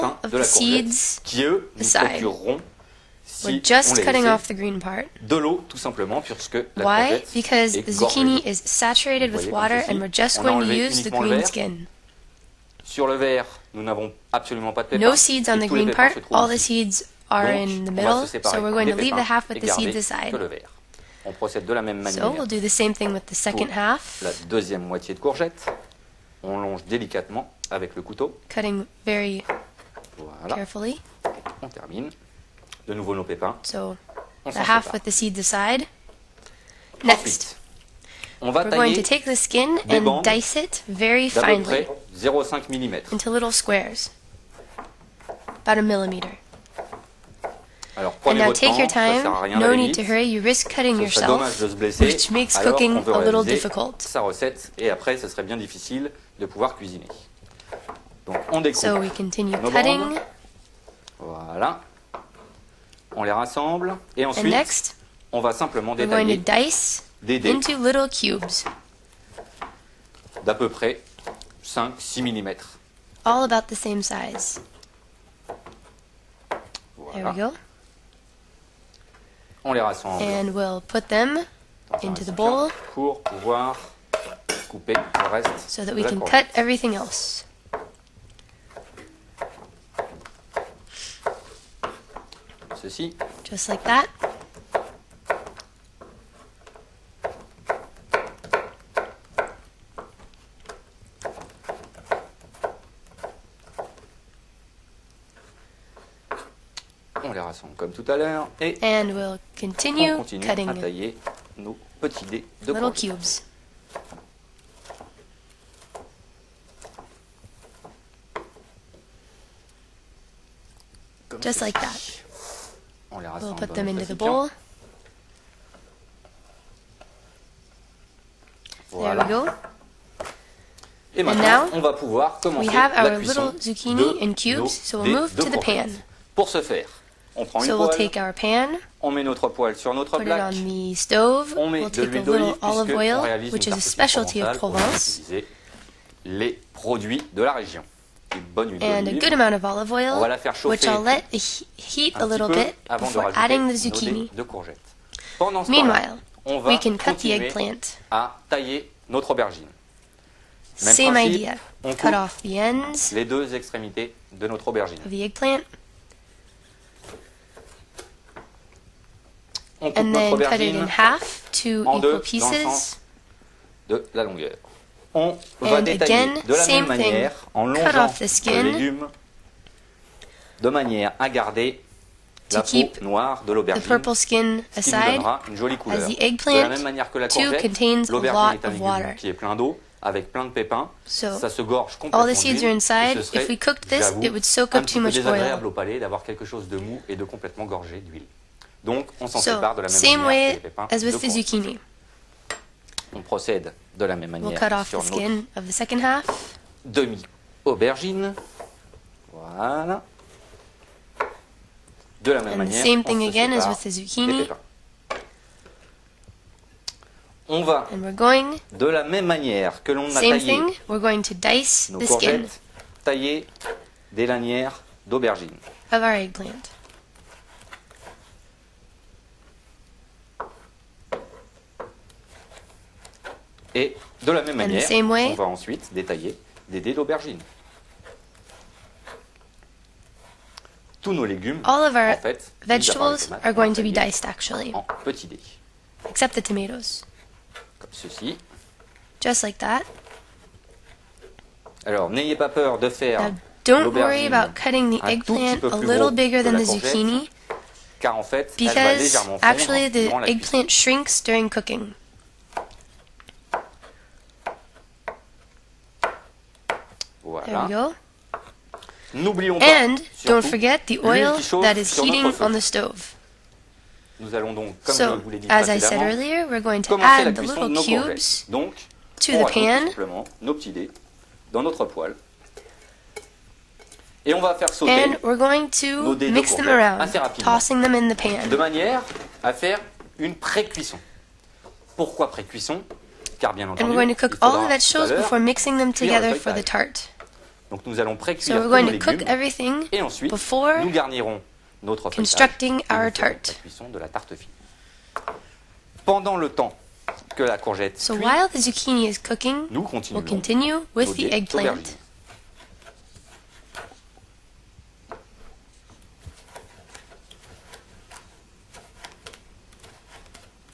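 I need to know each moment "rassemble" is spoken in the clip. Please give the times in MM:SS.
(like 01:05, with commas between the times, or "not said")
01:03, 01:19, 01:47.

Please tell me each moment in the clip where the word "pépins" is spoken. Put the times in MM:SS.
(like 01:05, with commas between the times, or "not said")
00:14, 00:33, 03:10, 03:20.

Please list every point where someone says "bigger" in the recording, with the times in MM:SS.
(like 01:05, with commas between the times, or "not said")
04:16.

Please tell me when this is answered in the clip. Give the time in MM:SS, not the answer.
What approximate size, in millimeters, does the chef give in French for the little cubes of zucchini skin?
01:10.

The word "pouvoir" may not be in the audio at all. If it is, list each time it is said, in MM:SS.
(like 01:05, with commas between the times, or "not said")
00:56, 01:23, 02:11.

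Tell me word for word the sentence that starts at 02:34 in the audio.
de Meanwhile, we can cut the eggplant.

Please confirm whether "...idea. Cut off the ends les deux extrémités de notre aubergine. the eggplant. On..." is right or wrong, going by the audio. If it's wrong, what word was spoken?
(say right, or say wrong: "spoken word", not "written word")
right.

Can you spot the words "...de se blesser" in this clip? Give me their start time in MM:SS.
00:51.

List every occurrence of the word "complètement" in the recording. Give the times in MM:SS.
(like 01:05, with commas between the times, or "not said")
03:11, 03:17.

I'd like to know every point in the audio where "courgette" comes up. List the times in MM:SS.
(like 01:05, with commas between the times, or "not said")
00:00, 00:25, 03:07, 05:07.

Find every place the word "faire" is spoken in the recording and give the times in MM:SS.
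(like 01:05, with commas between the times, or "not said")
02:16, 04:12, 04:49.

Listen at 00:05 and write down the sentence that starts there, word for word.
De l'eau, tout simplement, puisque la Why?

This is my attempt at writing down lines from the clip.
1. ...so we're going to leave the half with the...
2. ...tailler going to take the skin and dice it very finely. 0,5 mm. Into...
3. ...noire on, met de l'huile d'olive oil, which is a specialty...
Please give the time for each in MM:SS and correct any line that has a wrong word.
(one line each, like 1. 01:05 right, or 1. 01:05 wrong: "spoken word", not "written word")
1. 00:18 right
2. 00:38 right
3. 02:19 wrong: "notre", not "noire".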